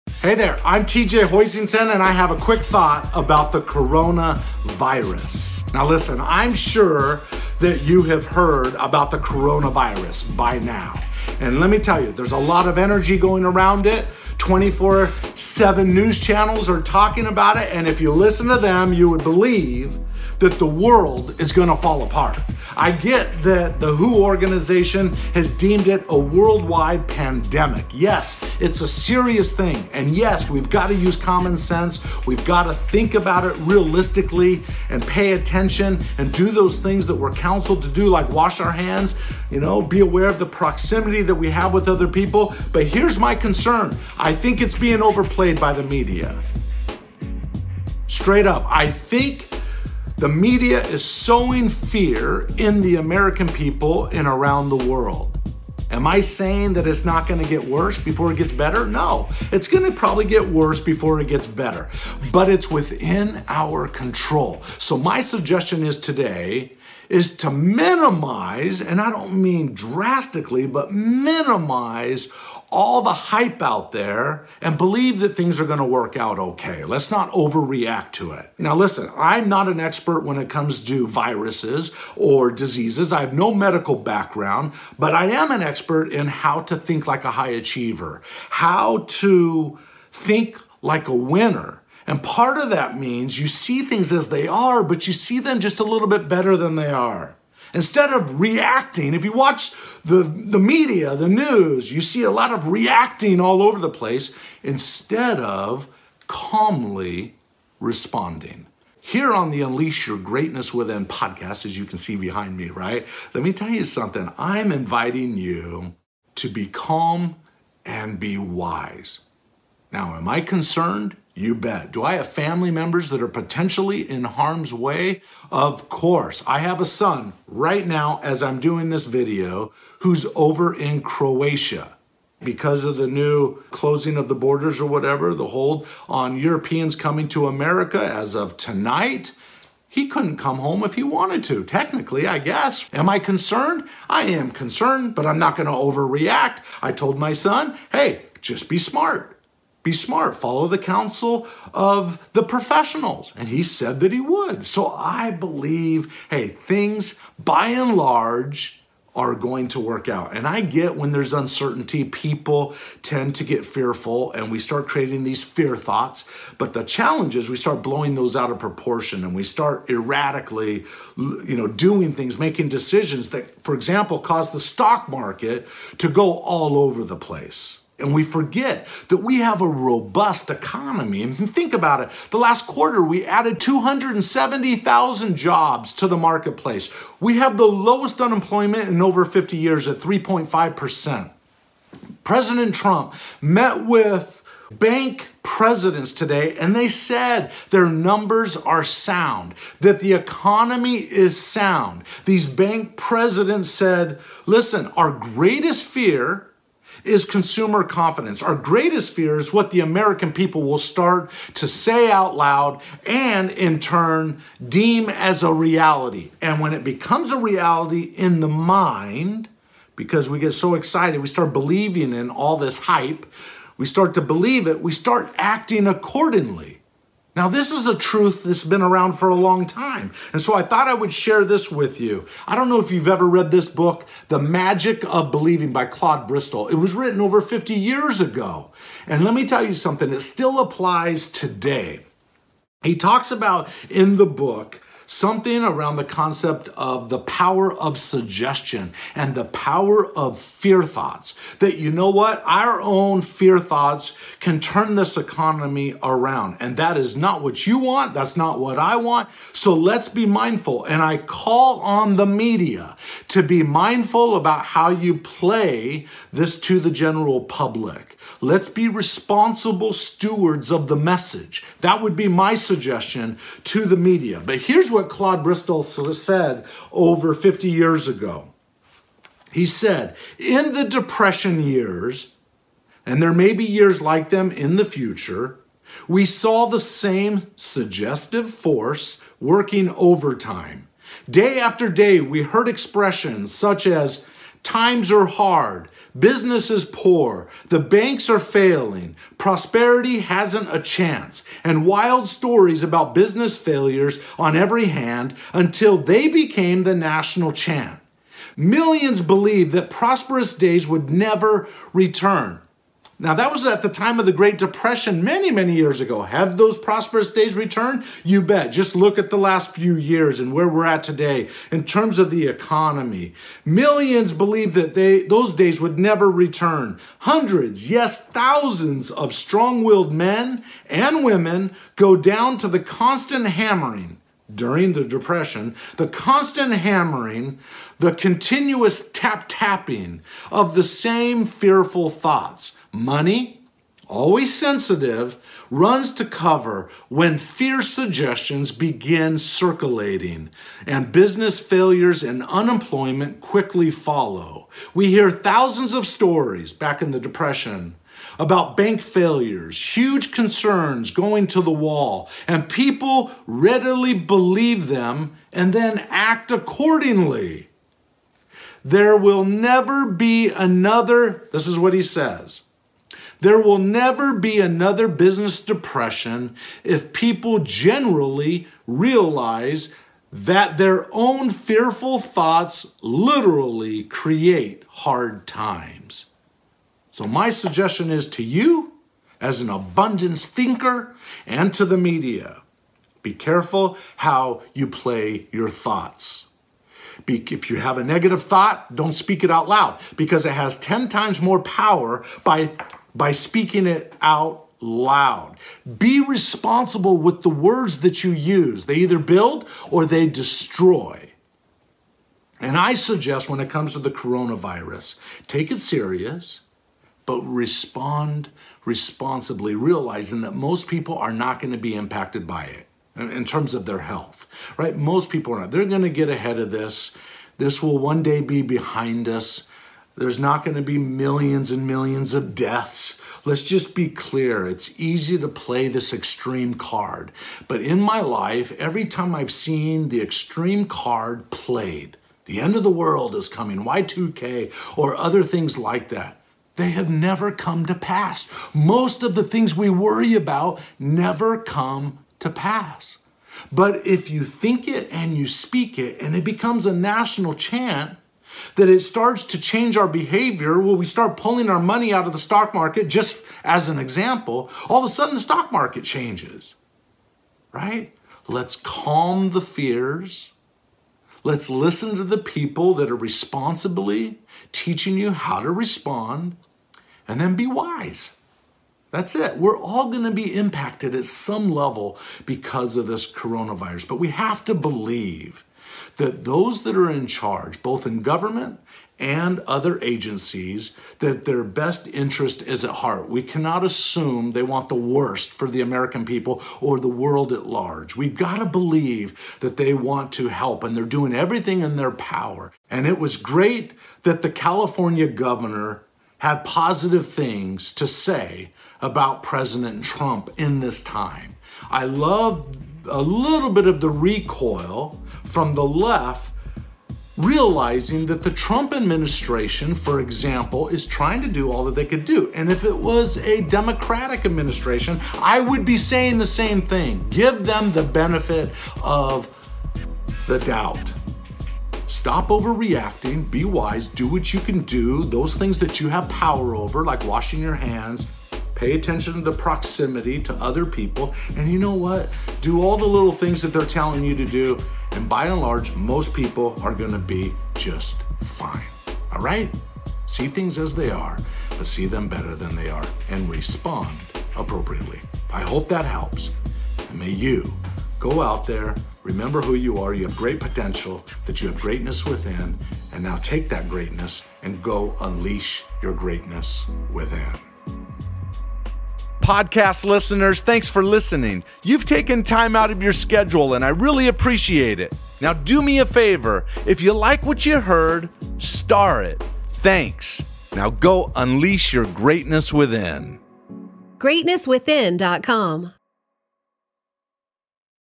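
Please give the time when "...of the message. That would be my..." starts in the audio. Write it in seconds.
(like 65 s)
270 s.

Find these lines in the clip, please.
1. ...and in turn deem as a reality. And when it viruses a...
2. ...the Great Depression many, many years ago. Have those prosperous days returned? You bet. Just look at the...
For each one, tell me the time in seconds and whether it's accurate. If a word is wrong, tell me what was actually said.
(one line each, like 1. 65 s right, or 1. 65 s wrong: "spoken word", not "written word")
1. 213 s wrong: "becomes", not "viruses"
2. 314 s right.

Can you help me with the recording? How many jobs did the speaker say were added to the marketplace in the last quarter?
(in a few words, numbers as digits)
270,000.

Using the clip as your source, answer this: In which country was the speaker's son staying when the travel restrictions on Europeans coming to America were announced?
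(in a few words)
Croatia.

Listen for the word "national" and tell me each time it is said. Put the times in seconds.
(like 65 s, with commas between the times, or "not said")
306 s, 456 s.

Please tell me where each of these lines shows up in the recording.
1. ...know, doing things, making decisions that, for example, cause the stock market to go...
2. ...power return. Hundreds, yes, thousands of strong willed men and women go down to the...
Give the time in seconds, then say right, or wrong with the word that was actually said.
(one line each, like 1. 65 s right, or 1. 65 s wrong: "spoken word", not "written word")
1. 171 s right
2. 325 s wrong: "never", not "power".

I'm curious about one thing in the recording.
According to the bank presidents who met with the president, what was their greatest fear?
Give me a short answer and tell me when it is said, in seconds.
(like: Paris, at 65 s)
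Consumer confidence, at 207 s.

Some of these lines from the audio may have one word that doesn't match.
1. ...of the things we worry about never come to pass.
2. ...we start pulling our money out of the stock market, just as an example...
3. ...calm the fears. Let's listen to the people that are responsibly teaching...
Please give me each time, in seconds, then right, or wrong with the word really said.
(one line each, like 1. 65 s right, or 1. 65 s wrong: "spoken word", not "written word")
1. 449 s right
2. 460 s right
3. 468 s right.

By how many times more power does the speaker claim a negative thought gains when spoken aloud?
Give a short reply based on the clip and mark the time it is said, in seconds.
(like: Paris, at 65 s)
10 times, at 400 s.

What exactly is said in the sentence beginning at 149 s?
Be smart, follow the counsel of the professionals.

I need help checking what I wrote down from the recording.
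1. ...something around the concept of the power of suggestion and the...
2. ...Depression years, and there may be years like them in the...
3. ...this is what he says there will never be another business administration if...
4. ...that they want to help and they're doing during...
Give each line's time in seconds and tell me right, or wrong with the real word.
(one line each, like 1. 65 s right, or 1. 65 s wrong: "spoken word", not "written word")
1. 245 s right
2. 280 s right
3. 371 s wrong: "depression", not "administration"
4. 499 s wrong: "everything", not "during".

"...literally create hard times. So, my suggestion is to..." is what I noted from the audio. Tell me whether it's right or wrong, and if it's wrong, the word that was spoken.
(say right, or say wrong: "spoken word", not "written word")
right.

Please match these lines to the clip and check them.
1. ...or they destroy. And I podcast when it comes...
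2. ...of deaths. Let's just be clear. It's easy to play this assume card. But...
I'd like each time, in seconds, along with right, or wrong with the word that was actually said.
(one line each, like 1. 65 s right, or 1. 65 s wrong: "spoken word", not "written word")
1. 409 s wrong: "suggest", not "podcast"
2. 432 s wrong: "extreme", not "assume".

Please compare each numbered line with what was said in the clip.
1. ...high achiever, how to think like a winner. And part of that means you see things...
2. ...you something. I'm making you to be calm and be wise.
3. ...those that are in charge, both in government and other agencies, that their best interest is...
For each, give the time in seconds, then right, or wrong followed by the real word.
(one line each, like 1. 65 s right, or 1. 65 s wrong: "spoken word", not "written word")
1. 87 s right
2. 113 s wrong: "inviting", not "making"
3. 486 s right.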